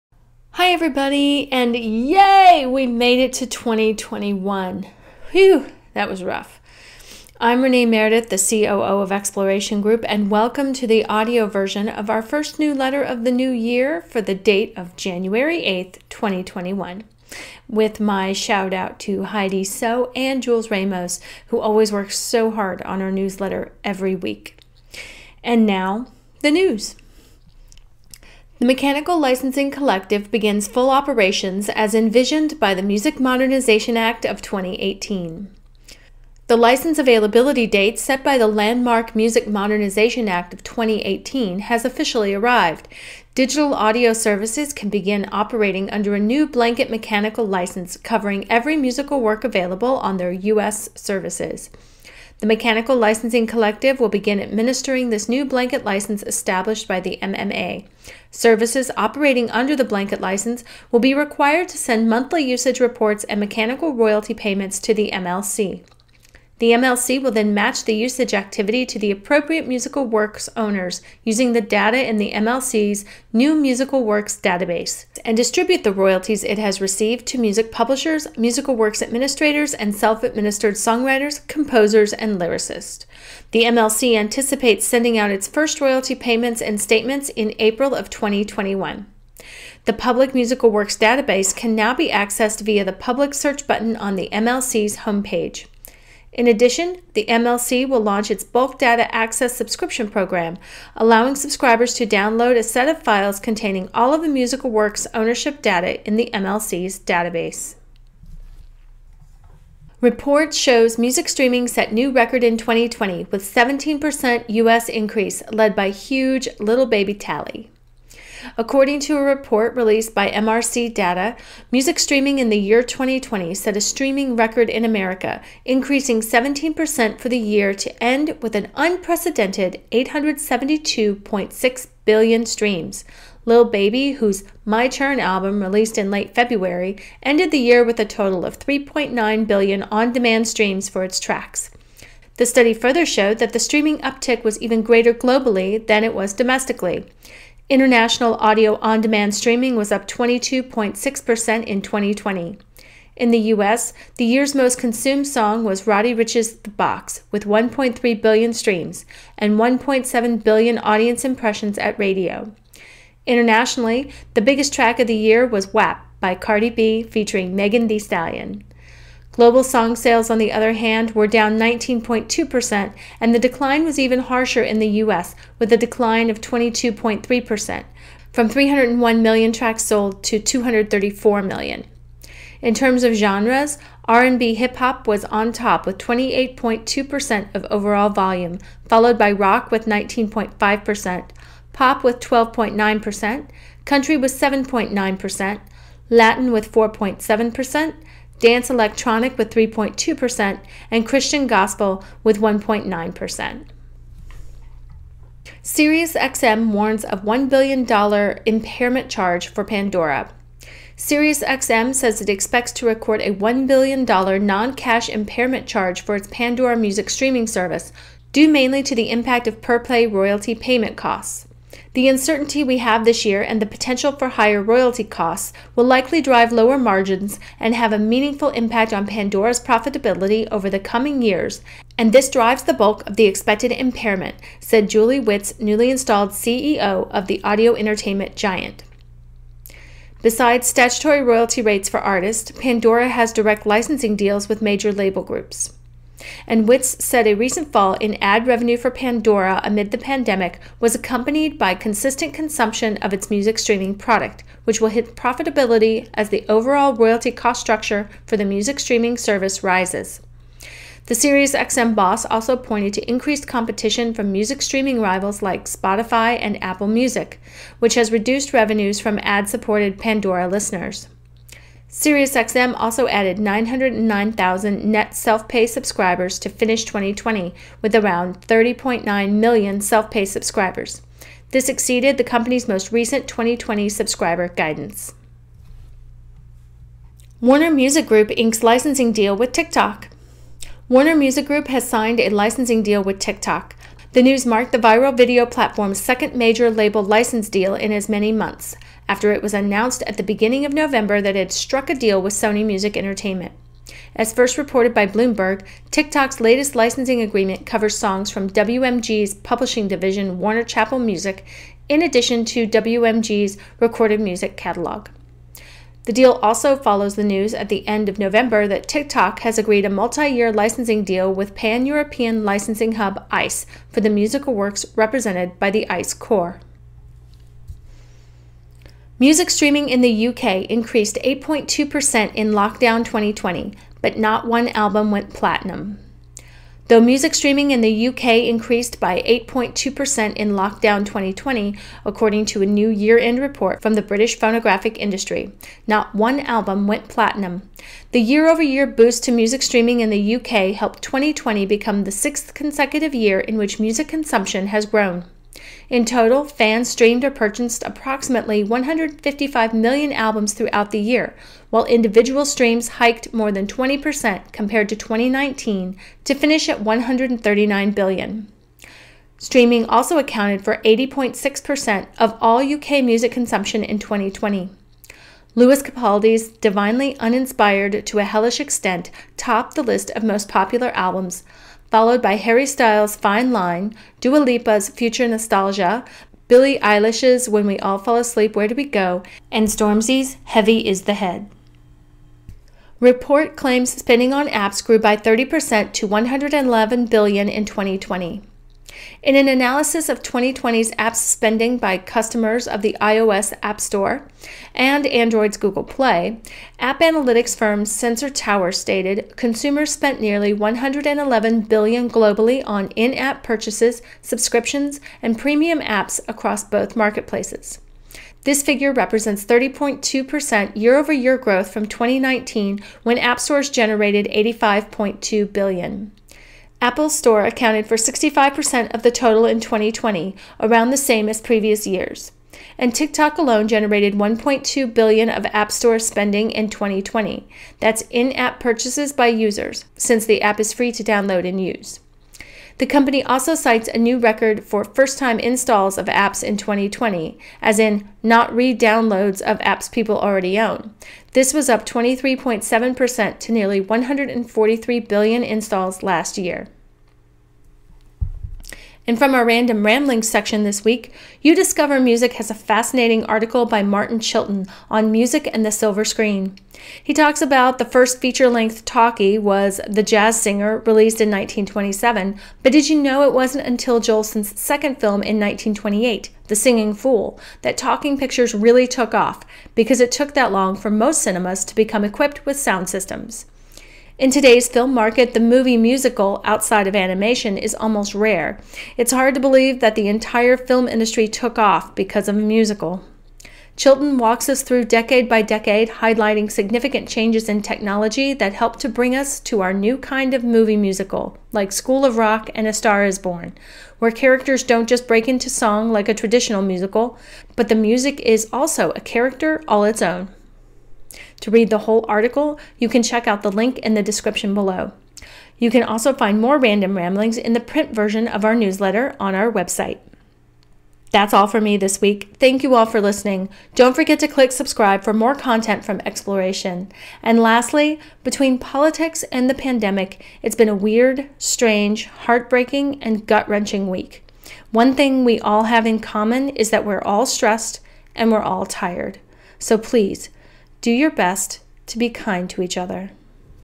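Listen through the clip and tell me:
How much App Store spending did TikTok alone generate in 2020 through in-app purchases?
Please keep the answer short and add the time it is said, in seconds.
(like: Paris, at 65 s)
1.2 billion, at 434 s.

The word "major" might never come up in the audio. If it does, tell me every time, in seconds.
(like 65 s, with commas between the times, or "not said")
244 s, 296 s.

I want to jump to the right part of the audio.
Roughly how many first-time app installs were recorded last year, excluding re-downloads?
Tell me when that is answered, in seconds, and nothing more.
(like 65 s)
453 s.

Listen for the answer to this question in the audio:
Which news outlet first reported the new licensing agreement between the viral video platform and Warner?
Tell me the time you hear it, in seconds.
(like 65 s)
305 s.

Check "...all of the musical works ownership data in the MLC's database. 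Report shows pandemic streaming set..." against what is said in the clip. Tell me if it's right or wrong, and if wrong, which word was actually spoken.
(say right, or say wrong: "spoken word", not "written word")
wrong: "music", not "pandemic".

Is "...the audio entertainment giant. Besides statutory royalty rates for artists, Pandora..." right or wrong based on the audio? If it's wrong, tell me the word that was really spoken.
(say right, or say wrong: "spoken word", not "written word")
right.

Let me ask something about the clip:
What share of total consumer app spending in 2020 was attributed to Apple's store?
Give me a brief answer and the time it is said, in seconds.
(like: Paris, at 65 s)
65%, at 427 s.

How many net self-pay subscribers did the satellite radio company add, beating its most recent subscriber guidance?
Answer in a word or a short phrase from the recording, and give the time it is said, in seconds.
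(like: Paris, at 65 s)
909,000, at 273 s.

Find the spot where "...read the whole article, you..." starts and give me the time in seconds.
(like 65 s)
511 s.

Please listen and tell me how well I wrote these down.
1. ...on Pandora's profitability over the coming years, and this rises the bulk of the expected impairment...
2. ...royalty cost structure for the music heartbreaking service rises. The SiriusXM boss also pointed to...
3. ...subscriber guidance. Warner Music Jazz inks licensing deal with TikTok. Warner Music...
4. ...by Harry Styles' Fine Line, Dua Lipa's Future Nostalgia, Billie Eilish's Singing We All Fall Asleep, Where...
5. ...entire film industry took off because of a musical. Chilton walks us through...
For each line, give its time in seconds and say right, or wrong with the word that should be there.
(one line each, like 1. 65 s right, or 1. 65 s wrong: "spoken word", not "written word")
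1. 228 s wrong: "drives", not "rises"
2. 256 s wrong: "streaming", not "heartbreaking"
3. 283 s wrong: "Group", not "Jazz"
4. 382 s wrong: "When", not "Singing"
5. 490 s right.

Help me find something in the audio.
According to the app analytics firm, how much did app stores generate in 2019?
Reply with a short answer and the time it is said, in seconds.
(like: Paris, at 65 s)
85.2 billion, at 424 s.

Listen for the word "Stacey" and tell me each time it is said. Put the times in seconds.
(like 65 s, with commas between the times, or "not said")
not said.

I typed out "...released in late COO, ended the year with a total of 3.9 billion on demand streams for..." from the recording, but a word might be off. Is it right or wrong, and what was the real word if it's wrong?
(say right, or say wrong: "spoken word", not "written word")
wrong: "February", not "COO".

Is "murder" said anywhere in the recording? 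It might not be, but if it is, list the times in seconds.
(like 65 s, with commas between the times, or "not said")
not said.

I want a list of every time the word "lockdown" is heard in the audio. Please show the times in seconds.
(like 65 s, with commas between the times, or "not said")
332 s, 340 s.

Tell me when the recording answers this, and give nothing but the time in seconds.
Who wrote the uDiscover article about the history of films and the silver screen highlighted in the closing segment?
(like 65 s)
463 s.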